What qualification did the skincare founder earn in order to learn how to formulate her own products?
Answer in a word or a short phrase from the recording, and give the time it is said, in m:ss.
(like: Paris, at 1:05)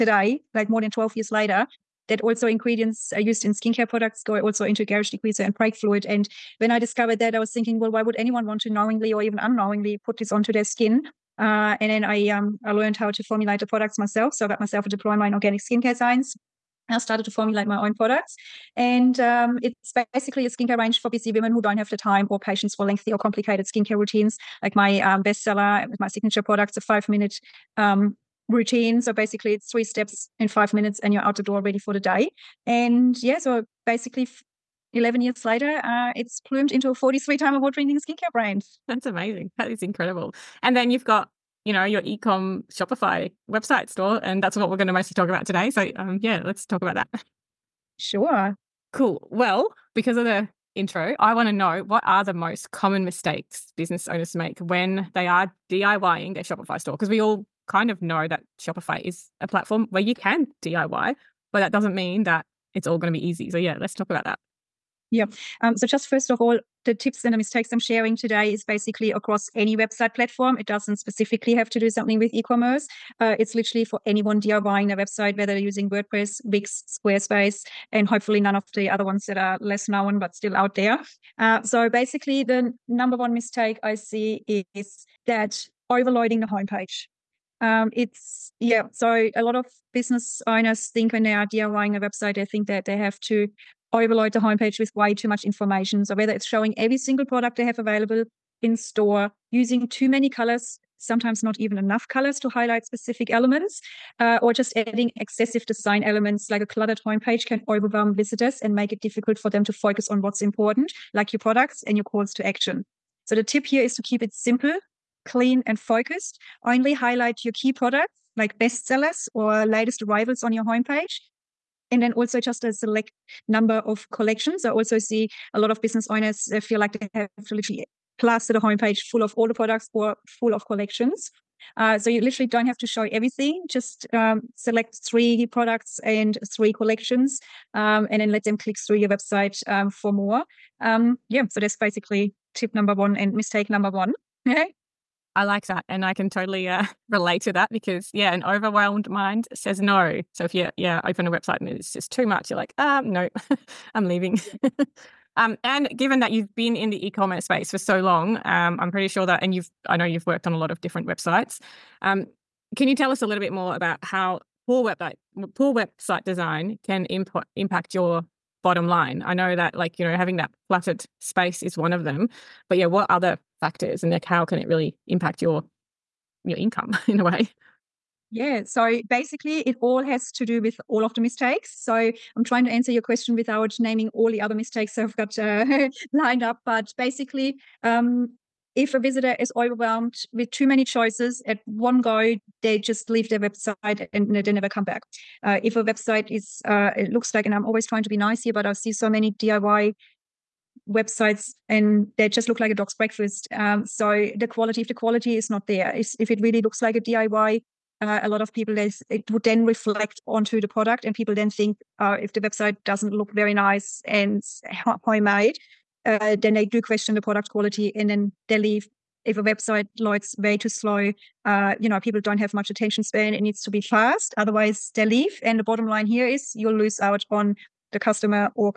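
Diploma in organic skincare science, at 0:14.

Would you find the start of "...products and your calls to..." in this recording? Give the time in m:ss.
1:51.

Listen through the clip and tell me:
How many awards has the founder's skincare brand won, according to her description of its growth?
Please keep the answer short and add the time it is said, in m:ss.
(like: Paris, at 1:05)
43, at 0:36.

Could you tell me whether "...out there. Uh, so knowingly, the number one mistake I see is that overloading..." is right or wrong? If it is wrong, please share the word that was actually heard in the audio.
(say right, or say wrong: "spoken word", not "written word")
wrong: "basically", not "knowingly".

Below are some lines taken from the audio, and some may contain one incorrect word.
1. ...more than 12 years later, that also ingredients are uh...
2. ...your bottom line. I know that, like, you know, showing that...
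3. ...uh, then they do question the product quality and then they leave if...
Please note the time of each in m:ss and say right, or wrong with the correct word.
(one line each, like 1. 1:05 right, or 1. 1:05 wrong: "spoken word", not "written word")
1. 0:00 right
2. 2:47 wrong: "having", not "showing"
3. 3:36 right.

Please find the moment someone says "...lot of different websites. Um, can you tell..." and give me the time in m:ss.
2:40.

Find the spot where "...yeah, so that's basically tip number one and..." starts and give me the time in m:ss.
2:21.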